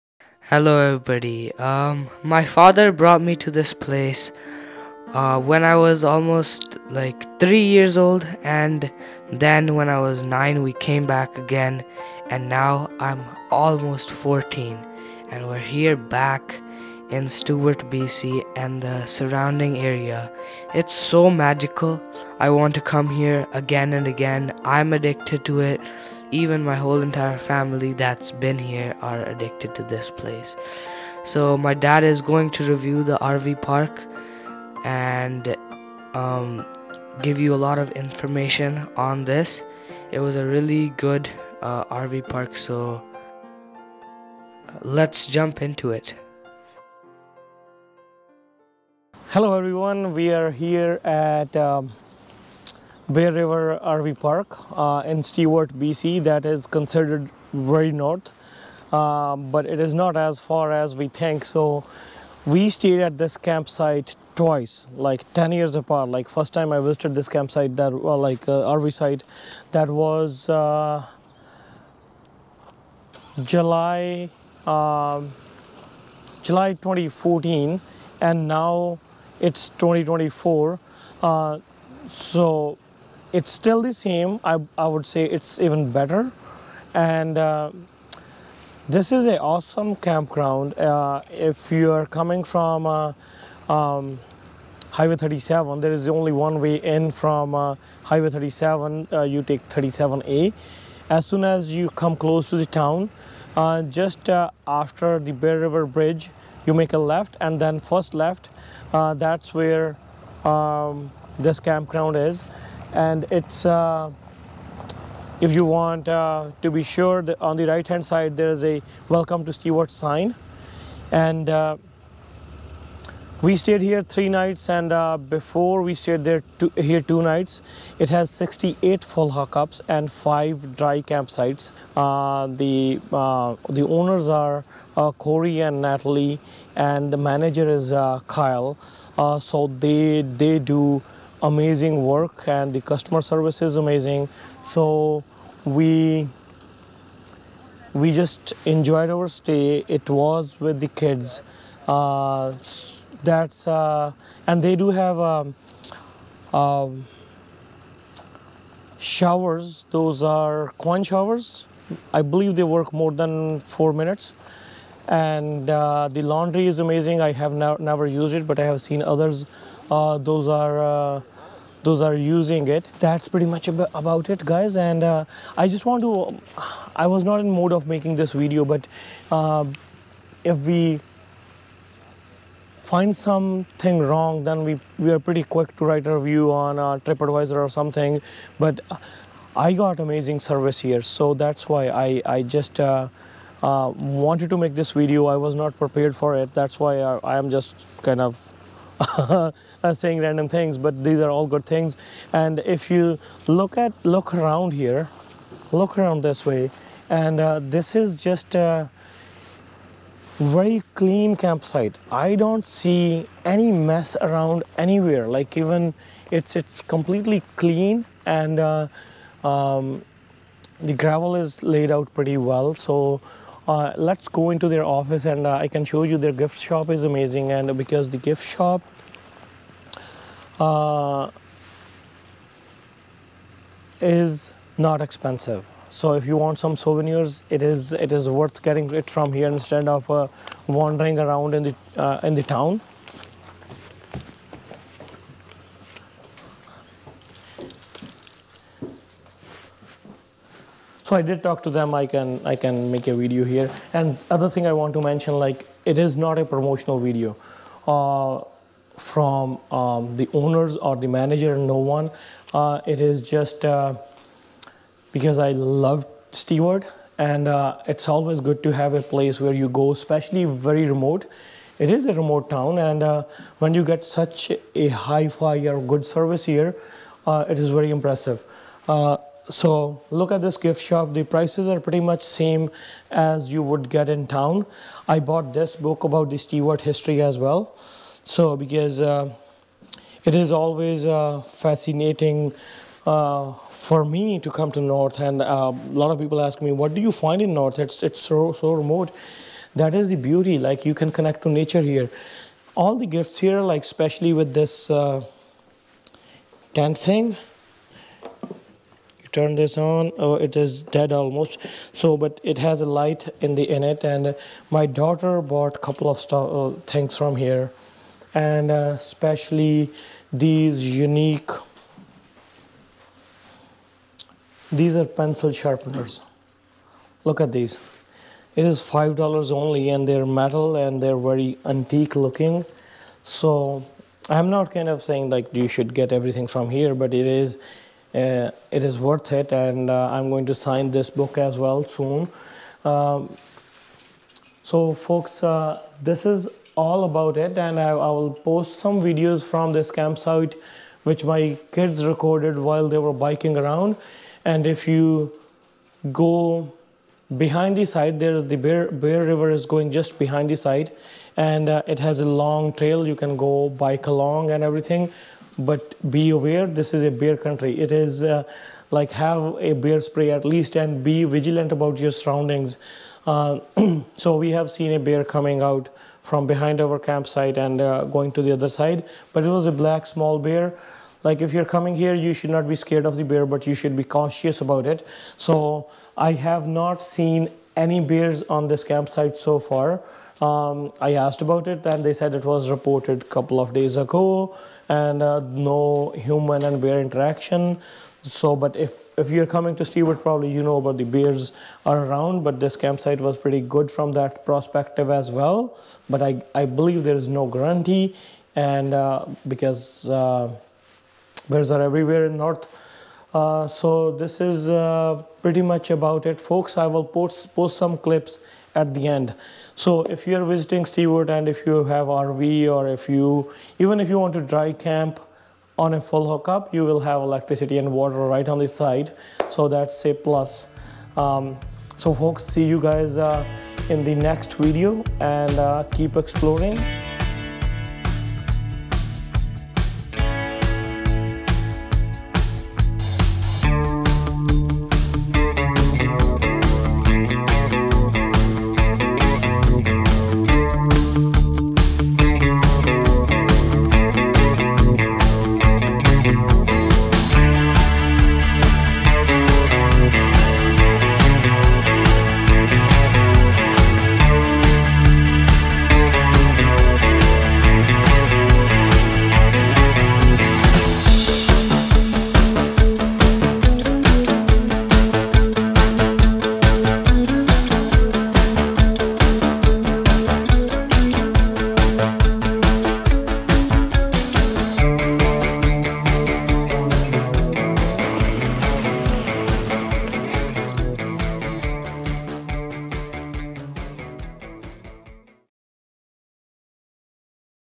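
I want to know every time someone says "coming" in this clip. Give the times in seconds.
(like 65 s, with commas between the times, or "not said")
92 s, 375 s, 381 s, 399 s.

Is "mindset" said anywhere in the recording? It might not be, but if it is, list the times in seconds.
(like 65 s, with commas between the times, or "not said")
not said.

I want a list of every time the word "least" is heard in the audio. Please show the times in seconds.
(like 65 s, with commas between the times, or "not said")
370 s.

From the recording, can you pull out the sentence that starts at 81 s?
Uh, so it's still the same.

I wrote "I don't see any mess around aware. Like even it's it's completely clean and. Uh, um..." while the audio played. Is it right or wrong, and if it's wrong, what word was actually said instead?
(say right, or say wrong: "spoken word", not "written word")
wrong: "anywhere", not "aware".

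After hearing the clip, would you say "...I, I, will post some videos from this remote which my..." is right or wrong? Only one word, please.
wrong.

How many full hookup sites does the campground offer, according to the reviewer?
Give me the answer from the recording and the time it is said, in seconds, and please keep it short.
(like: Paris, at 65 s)
68, at 128 s.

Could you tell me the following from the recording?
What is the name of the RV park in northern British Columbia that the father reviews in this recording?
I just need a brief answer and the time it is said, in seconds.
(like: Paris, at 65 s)
Bear River RV Park, at 53 s.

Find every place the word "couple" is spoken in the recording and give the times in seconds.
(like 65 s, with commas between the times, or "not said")
315 s, 393 s.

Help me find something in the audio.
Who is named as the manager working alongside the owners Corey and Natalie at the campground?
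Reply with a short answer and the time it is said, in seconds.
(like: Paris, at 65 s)
Kyle, at 138 s.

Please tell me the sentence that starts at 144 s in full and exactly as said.
So we we just enjoyed our stay.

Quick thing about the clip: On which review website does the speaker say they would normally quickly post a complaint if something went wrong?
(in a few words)
TripAdvisor.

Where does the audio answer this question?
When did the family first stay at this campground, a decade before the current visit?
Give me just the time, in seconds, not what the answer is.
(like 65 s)
76 s.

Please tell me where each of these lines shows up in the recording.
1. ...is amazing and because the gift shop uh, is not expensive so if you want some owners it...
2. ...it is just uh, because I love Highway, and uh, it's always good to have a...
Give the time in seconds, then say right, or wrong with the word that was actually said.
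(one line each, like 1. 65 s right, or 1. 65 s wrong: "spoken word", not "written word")
1. 226 s wrong: "souvenirs", not "owners"
2. 262 s wrong: "Stewart", not "Highway".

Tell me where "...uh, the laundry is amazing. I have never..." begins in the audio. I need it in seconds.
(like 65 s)
165 s.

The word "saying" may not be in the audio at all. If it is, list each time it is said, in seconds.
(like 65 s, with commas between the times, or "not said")
199 s, 335 s.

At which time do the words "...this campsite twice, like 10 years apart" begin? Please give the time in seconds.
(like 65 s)
63 s.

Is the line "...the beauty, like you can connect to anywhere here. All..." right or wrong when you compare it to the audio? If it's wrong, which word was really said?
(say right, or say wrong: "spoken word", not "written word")
wrong: "nature", not "anywhere".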